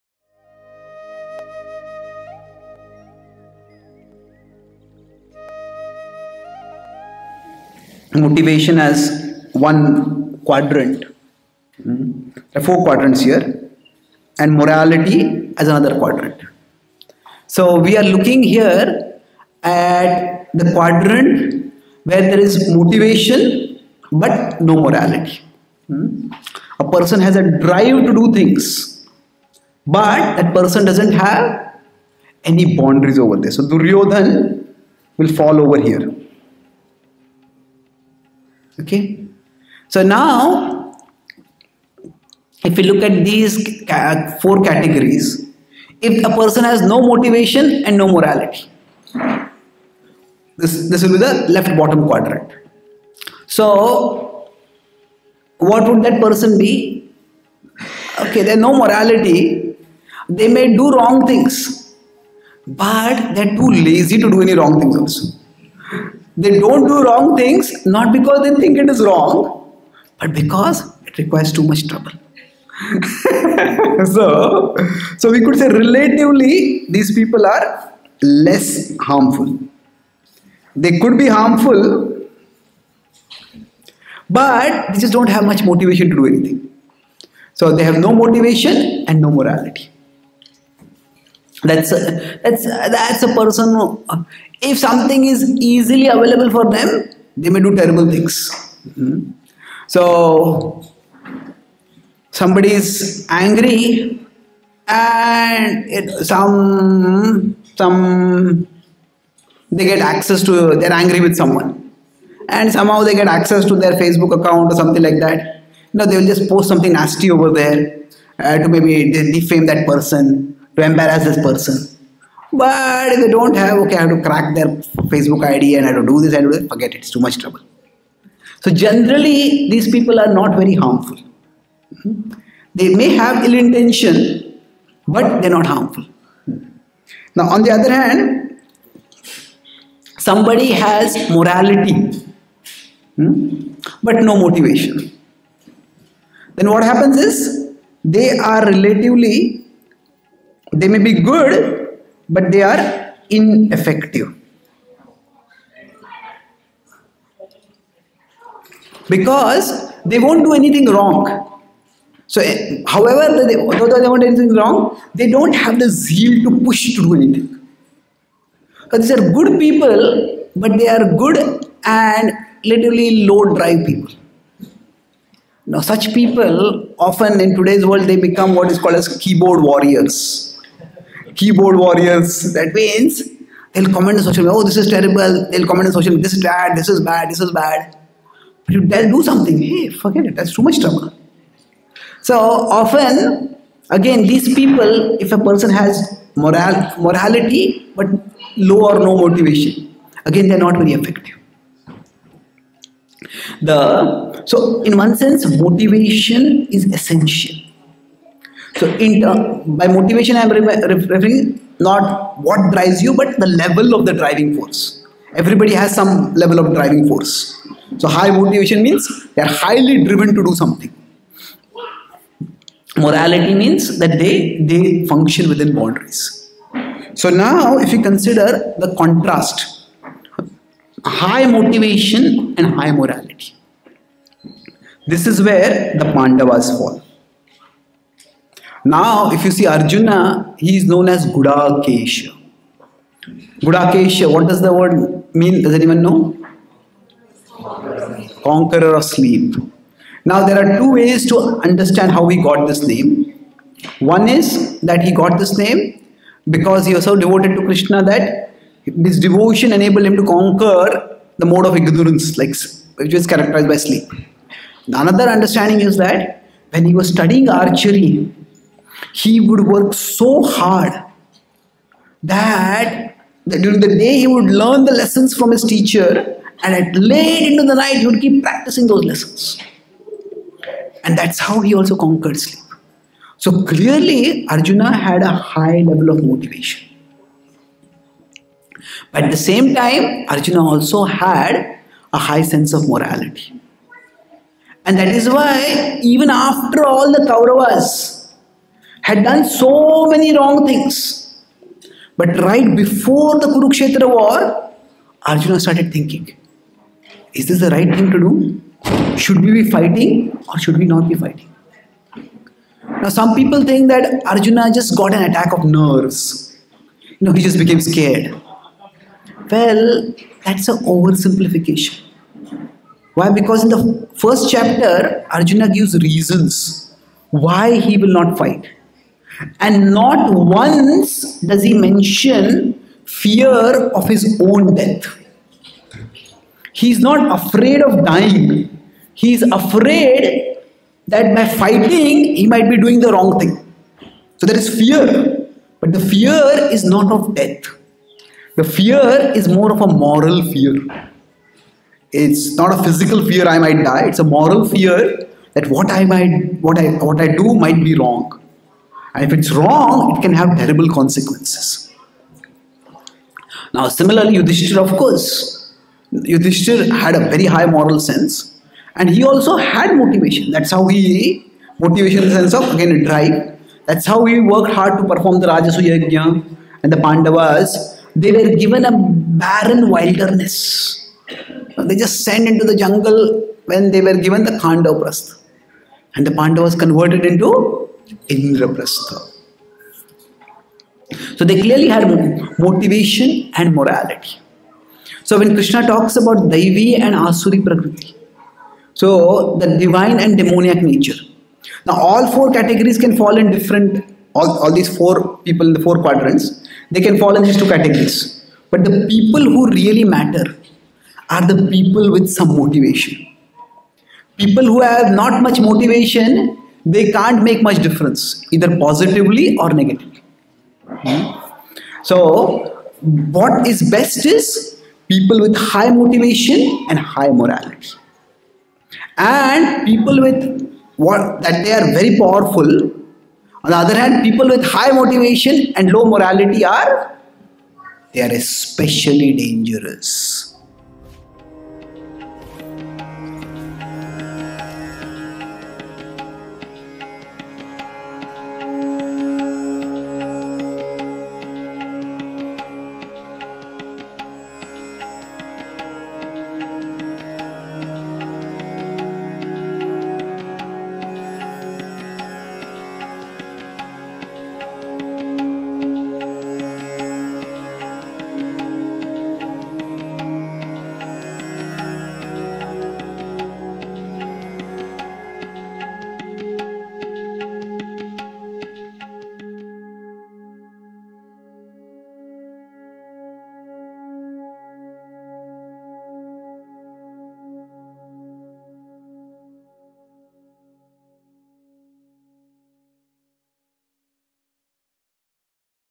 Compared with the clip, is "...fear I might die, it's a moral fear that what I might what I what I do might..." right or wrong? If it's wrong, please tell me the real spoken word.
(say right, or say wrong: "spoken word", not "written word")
right.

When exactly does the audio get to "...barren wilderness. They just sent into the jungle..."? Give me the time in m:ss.
6:18.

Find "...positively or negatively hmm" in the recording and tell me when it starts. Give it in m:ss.
6:58.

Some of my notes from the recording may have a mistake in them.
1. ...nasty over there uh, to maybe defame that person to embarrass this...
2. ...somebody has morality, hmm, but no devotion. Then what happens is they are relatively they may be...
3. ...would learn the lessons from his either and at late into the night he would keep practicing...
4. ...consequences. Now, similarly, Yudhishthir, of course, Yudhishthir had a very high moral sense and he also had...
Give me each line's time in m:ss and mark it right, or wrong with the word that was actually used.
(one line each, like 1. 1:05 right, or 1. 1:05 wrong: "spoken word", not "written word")
1. 1:56 right
2. 2:20 wrong: "motivation", not "devotion"
3. 4:34 wrong: "teacher", not "either"
4. 6:00 right.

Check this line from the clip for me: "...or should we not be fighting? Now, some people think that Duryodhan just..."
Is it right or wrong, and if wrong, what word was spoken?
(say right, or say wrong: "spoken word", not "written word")
wrong: "Arjuna", not "Duryodhan".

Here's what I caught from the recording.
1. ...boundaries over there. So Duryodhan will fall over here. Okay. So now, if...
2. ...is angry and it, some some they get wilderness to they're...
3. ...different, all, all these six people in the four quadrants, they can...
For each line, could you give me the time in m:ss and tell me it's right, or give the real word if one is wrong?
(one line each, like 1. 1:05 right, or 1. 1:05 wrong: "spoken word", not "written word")
1. 0:32 right
2. 1:42 wrong: "access", not "wilderness"
3. 6:43 wrong: "four", not "six".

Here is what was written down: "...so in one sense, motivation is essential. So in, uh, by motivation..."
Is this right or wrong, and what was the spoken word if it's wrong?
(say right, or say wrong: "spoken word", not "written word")
right.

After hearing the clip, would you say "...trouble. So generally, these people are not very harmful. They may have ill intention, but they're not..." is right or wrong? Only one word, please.
right.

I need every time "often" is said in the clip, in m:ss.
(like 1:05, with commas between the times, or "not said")
2:56, 3:12.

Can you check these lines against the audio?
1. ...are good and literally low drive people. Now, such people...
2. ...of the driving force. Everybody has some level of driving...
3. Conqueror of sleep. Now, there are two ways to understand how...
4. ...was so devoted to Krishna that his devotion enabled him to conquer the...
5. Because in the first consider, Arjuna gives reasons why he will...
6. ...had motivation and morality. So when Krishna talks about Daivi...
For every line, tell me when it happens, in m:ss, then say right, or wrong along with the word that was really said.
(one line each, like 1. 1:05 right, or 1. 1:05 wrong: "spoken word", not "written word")
1. 2:50 right
2. 3:33 right
3. 4:08 right
4. 4:16 right
5. 5:23 wrong: "chapter", not "consider"
6. 6:31 right.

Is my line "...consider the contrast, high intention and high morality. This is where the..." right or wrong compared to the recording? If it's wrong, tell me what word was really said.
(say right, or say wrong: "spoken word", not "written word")
wrong: "motivation", not "intention".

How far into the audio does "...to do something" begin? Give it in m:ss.
3:40.